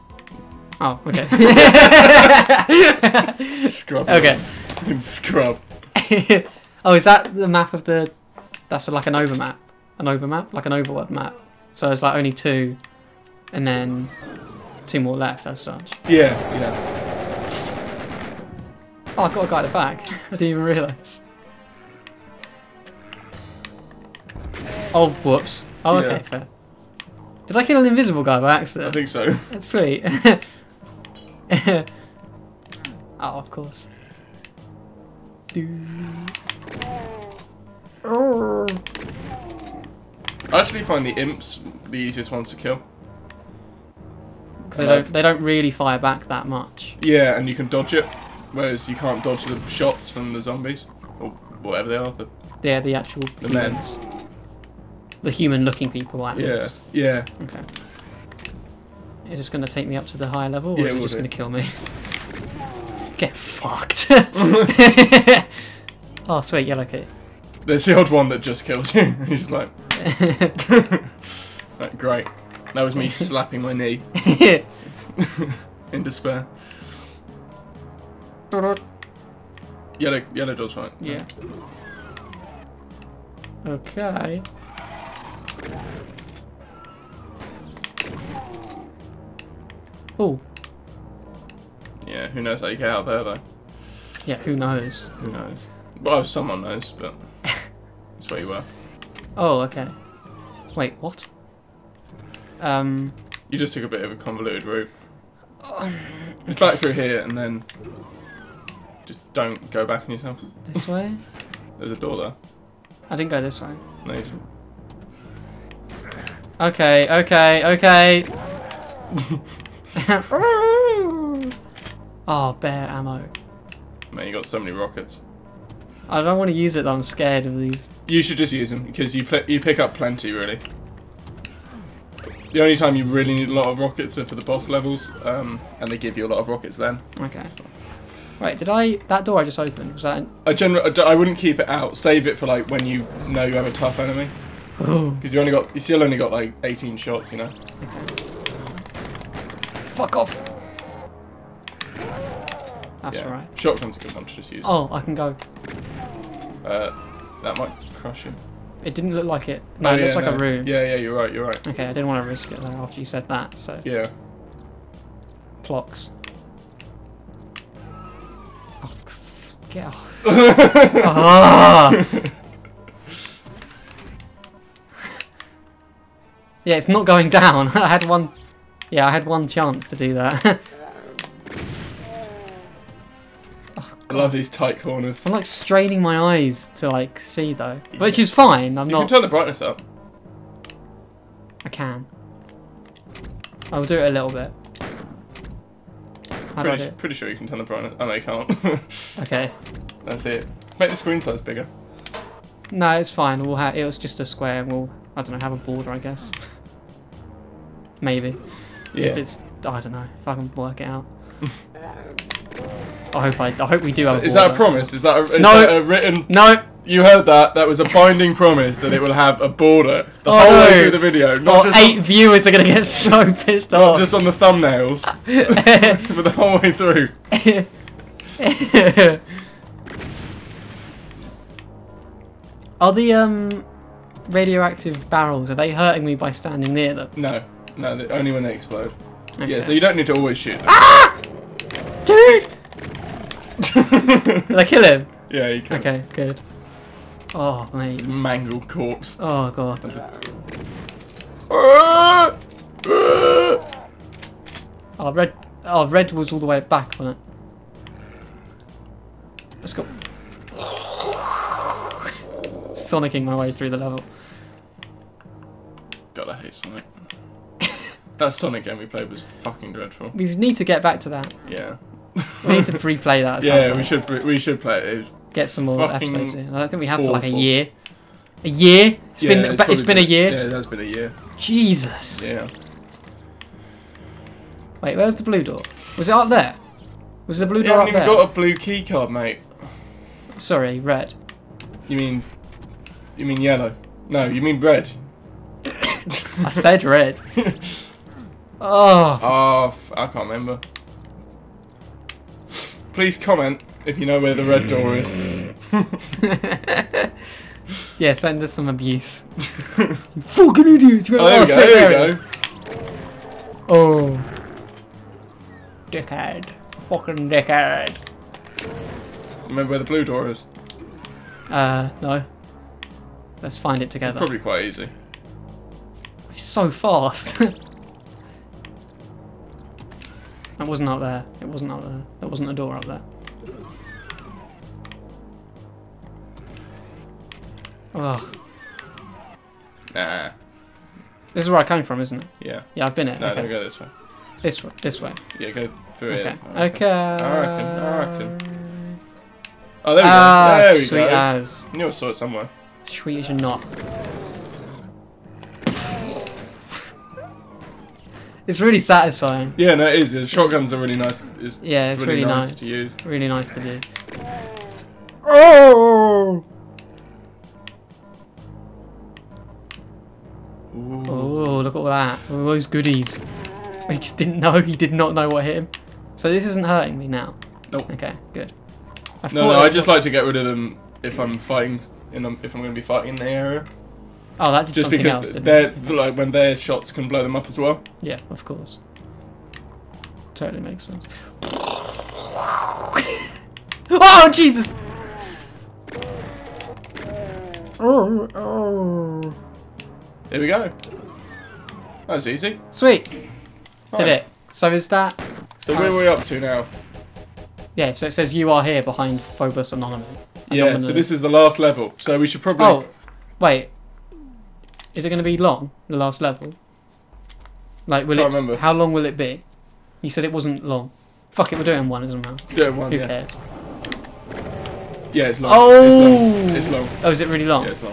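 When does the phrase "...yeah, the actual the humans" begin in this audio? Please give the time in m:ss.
0:52.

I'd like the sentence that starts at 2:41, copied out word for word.
Okay, I didn't want to risk it though after you said that, so.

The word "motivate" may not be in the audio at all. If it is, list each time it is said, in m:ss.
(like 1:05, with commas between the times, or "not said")
not said.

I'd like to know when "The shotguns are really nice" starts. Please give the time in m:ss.
6:00.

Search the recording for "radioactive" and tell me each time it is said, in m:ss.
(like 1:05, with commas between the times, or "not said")
3:54.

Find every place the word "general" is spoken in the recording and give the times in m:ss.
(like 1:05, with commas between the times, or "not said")
2:20.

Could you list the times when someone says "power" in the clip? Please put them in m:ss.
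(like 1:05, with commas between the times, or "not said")
not said.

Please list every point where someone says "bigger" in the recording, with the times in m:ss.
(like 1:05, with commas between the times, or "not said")
3:21.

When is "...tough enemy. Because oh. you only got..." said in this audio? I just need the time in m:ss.
2:23.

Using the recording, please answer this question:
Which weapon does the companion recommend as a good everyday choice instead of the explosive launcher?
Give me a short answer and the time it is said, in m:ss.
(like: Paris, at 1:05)
Shotgun, at 2:33.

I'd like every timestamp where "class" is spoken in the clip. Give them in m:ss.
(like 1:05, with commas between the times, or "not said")
not said.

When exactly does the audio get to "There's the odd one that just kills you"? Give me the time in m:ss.
1:07.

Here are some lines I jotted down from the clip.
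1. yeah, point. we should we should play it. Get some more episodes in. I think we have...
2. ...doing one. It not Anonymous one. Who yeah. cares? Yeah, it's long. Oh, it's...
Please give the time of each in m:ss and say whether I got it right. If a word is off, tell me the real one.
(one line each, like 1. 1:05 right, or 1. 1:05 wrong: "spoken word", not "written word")
1. 4:33 right
2. 7:01 wrong: "Doing", not "Anonymous".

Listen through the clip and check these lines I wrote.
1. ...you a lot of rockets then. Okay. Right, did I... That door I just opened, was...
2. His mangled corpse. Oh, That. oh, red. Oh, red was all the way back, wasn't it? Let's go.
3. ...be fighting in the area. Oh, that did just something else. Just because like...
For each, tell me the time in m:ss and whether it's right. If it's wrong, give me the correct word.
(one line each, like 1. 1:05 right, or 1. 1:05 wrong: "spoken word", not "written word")
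1. 2:16 right
2. 4:08 wrong: "God", not "That"
3. 6:22 right.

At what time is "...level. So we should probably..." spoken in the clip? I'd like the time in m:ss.
6:51.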